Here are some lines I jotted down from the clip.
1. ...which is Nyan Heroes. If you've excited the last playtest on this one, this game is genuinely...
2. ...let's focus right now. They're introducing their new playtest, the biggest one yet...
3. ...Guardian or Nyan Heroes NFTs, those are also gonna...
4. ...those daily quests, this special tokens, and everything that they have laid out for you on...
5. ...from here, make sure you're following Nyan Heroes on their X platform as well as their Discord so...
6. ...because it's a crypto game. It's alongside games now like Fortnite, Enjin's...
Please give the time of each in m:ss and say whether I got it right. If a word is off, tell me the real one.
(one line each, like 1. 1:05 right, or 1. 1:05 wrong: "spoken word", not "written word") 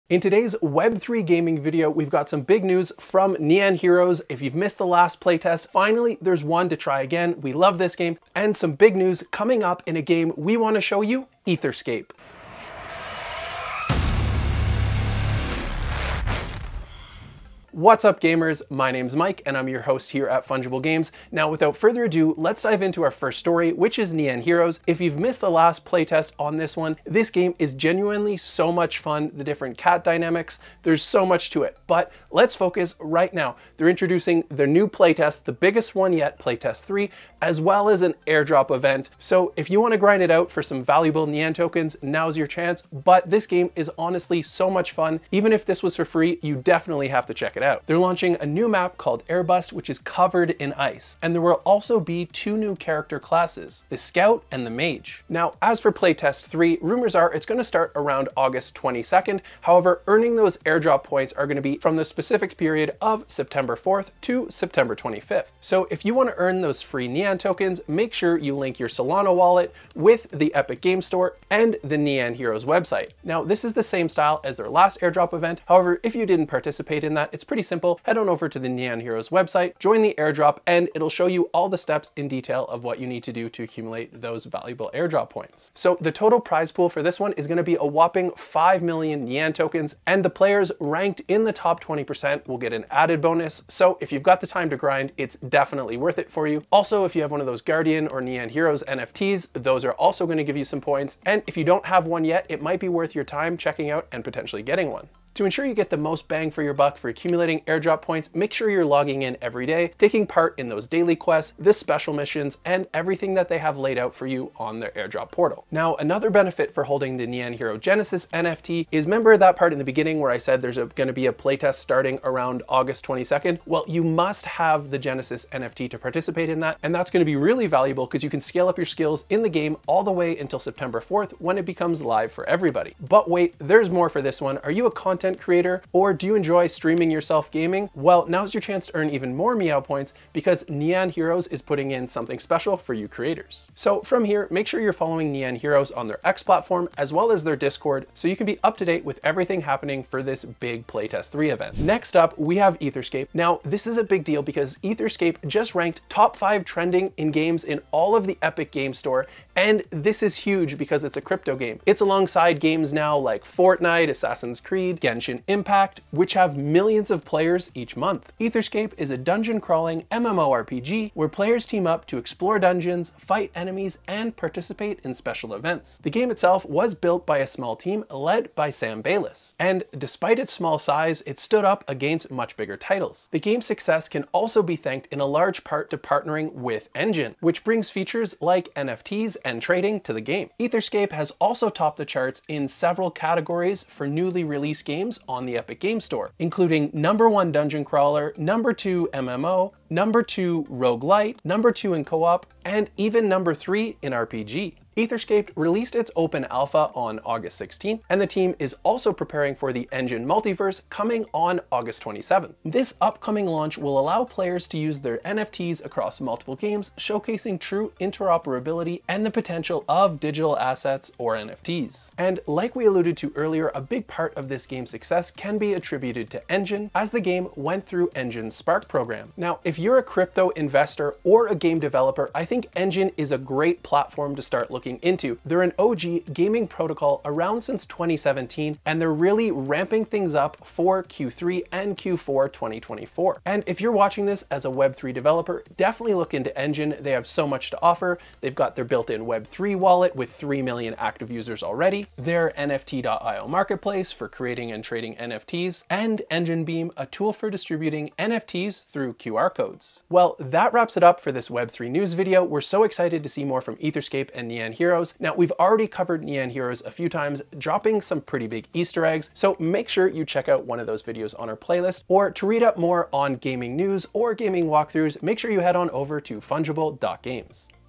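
1. 0:23 wrong: "missed", not "excited"
2. 0:32 right
3. 1:37 right
4. 1:50 wrong: "missions", not "tokens"
5. 2:24 right
6. 2:40 wrong: "Assassin", not "Enjin".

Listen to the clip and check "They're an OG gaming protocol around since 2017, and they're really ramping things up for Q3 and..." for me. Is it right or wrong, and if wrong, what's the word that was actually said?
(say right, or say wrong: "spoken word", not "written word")
right.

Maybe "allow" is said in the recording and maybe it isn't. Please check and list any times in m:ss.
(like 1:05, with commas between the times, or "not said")
3:33.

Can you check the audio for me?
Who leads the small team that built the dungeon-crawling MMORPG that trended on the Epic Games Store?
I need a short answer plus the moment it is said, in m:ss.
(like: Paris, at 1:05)
Sam Bayless, at 2:58.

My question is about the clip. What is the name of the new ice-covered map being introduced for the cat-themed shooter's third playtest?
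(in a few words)
Airbust.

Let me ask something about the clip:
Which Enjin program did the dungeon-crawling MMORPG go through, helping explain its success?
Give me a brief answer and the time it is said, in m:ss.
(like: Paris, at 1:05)
Spark, at 3:48.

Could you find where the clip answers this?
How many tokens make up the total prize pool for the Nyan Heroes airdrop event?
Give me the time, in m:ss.
1:28.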